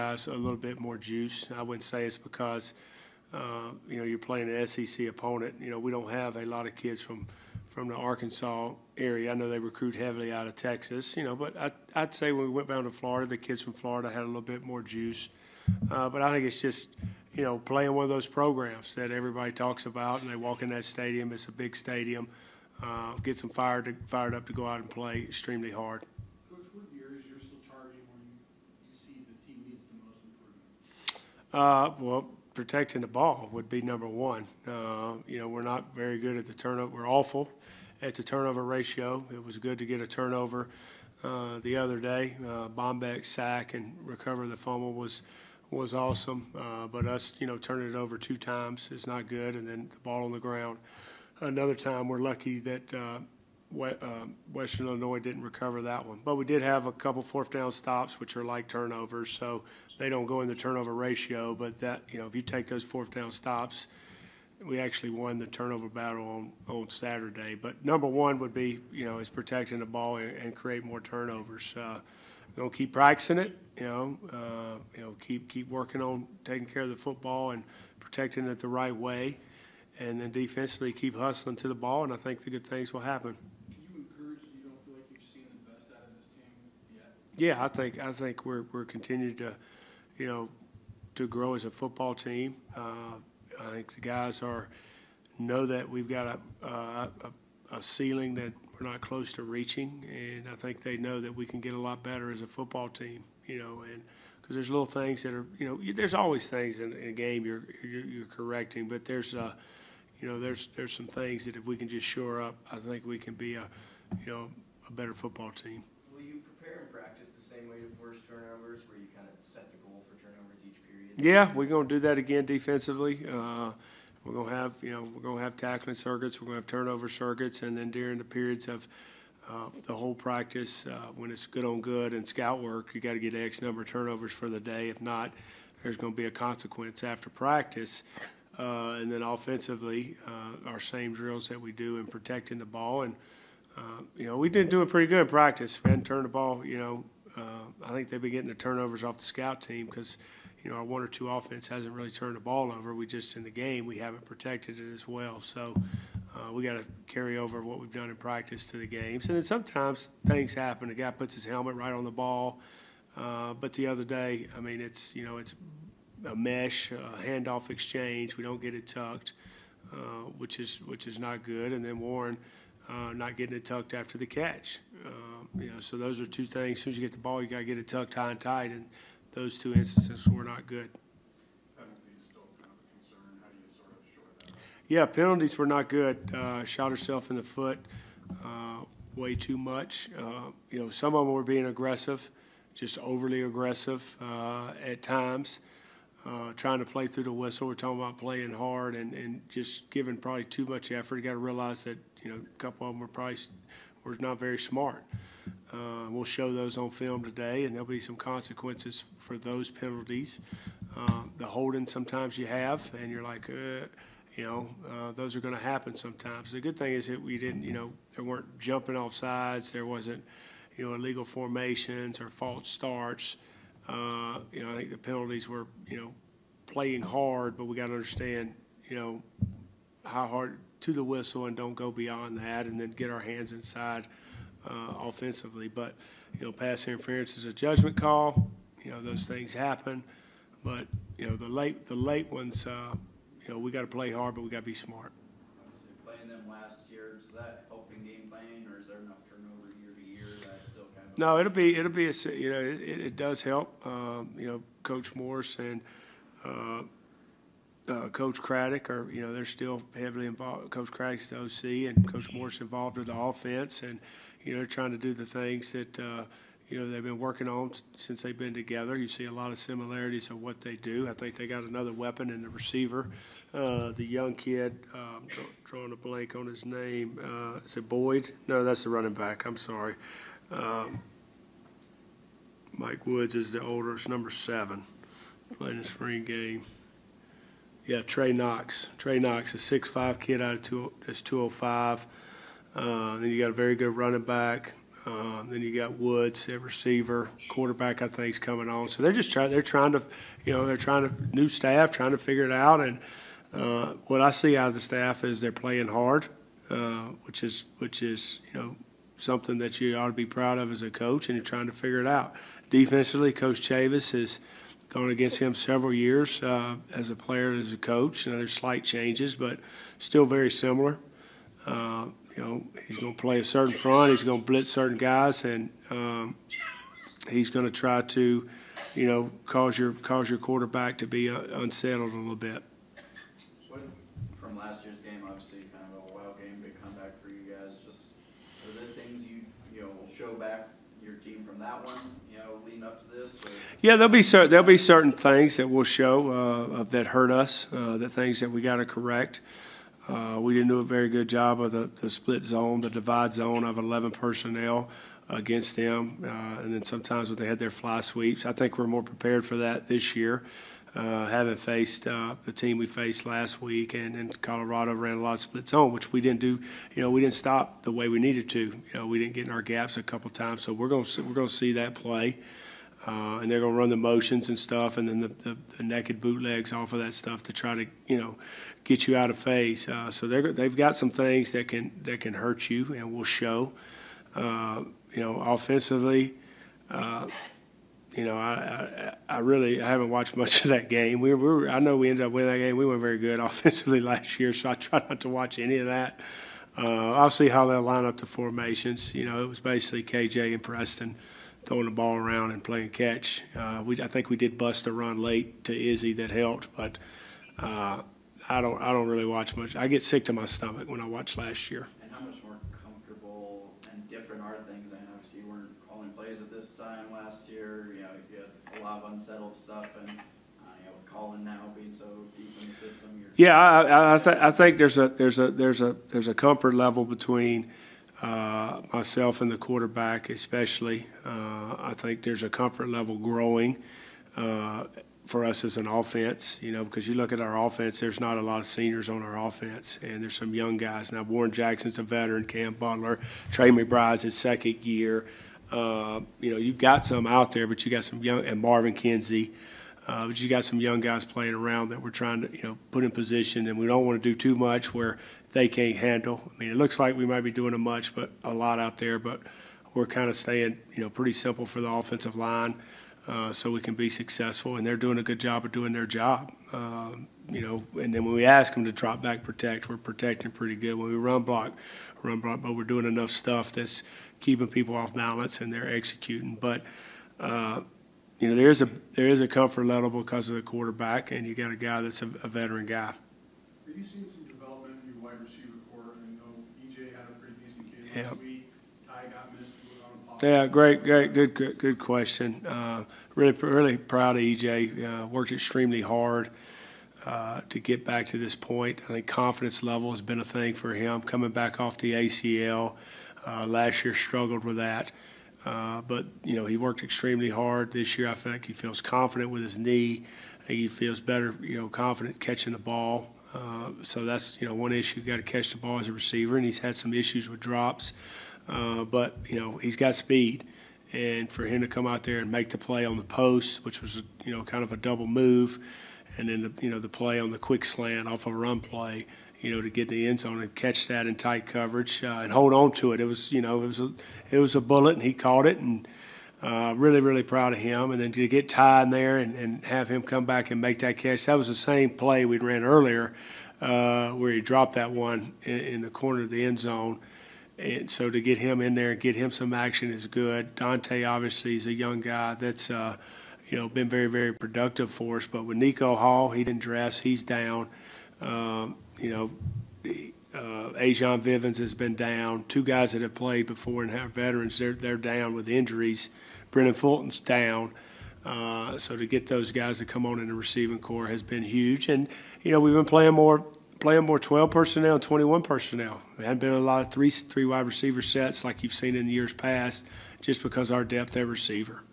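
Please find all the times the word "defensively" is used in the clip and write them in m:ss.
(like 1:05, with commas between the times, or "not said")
1:20, 2:02, 5:12.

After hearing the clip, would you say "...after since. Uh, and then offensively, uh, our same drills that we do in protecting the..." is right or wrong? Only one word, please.
wrong.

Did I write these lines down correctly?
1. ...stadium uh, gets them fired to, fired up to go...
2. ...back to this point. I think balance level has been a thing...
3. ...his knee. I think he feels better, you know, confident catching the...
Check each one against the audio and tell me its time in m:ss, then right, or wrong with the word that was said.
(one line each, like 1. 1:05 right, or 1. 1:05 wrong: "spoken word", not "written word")
1. 0:21 right
2. 8:18 wrong: "confidence", not "balance"
3. 8:29 right.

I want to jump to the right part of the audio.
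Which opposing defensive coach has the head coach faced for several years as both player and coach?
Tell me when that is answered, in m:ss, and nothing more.
5:13.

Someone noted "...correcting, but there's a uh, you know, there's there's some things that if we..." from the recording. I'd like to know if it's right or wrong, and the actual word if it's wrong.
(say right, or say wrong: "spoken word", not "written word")
right.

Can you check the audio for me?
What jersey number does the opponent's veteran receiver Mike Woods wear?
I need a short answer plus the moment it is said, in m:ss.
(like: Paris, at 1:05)
7, at 4:44.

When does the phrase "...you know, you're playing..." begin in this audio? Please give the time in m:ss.
0:03.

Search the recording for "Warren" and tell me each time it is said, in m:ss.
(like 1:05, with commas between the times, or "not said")
2:51, 7:21.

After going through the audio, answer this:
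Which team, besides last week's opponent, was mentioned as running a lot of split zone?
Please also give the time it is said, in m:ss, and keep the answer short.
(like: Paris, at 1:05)
Colorado, at 6:04.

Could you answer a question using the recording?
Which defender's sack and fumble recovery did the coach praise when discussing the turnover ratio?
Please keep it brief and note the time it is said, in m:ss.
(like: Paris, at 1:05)
Bombeck, at 0:42.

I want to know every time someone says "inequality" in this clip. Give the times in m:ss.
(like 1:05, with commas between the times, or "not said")
not said.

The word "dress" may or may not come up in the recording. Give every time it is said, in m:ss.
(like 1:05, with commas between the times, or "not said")
9:16.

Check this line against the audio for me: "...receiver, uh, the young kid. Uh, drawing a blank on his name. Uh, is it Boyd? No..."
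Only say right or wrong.
right.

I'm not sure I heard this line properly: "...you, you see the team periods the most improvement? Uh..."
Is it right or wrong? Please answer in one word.
wrong.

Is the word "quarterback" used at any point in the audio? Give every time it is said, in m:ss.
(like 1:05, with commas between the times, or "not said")
4:57, 5:30, 7:09, 8:00.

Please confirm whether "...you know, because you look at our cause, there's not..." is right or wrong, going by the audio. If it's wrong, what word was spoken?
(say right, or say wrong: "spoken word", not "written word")
wrong: "offense", not "cause".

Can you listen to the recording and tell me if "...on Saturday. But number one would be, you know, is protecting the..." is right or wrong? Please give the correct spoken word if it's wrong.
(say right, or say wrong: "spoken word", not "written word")
right.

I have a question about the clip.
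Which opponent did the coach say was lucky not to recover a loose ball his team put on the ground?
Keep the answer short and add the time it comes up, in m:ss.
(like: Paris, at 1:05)
Western Illinois, at 0:54.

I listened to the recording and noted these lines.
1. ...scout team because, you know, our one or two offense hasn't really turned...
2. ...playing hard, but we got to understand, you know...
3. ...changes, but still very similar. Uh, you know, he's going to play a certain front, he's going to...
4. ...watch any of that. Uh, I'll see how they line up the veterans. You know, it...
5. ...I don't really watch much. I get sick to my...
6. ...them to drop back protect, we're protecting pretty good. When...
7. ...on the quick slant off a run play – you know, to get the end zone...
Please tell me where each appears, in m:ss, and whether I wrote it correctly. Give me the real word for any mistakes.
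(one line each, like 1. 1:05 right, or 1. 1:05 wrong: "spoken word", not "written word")
1. 2:29 right
2. 3:46 right
3. 5:18 right
4. 6:35 wrong: "formations", not "veterans"
5. 6:48 right
6. 7:48 right
7. 8:47 right.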